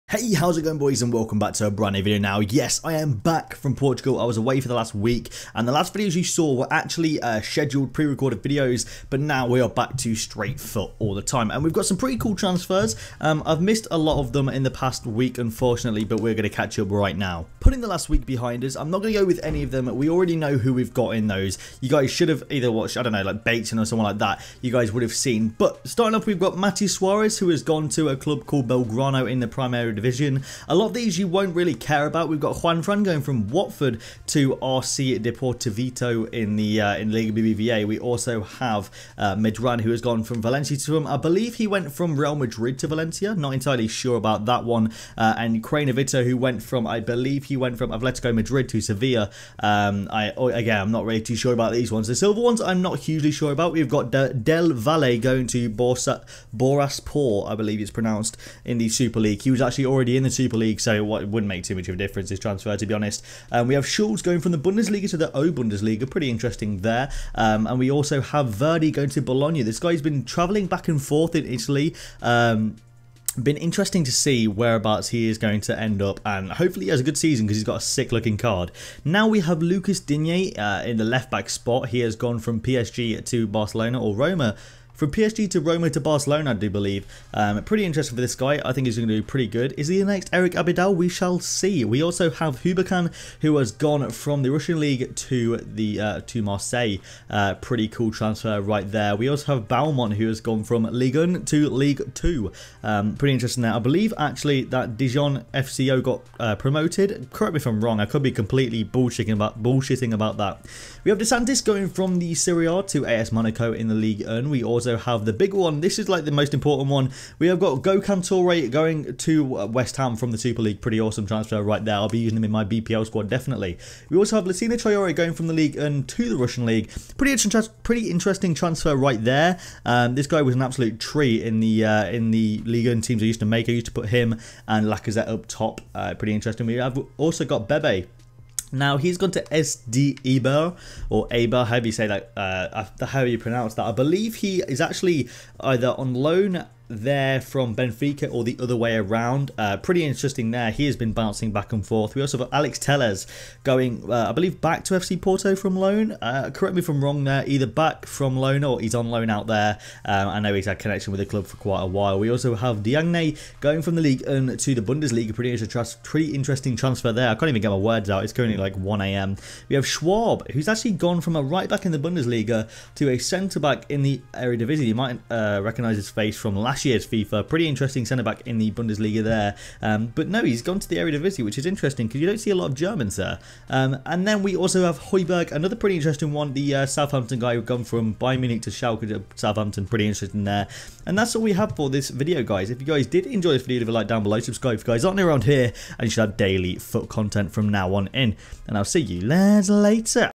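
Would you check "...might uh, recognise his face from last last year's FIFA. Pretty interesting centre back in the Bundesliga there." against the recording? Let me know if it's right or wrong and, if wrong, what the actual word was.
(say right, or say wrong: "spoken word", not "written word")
right.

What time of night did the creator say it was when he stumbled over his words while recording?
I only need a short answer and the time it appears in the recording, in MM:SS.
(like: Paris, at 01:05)
1 a.m., at 02:48.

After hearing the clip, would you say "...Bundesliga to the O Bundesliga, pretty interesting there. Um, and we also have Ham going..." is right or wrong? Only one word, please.
wrong.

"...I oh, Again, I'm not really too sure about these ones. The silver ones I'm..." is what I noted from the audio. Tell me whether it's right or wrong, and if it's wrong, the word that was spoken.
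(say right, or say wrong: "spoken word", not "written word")
right.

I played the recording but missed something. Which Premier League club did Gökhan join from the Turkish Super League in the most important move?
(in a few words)
West Ham.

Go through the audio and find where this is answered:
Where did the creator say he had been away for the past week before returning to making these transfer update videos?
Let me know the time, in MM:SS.
00:03.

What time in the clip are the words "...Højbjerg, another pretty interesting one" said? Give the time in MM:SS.
03:04.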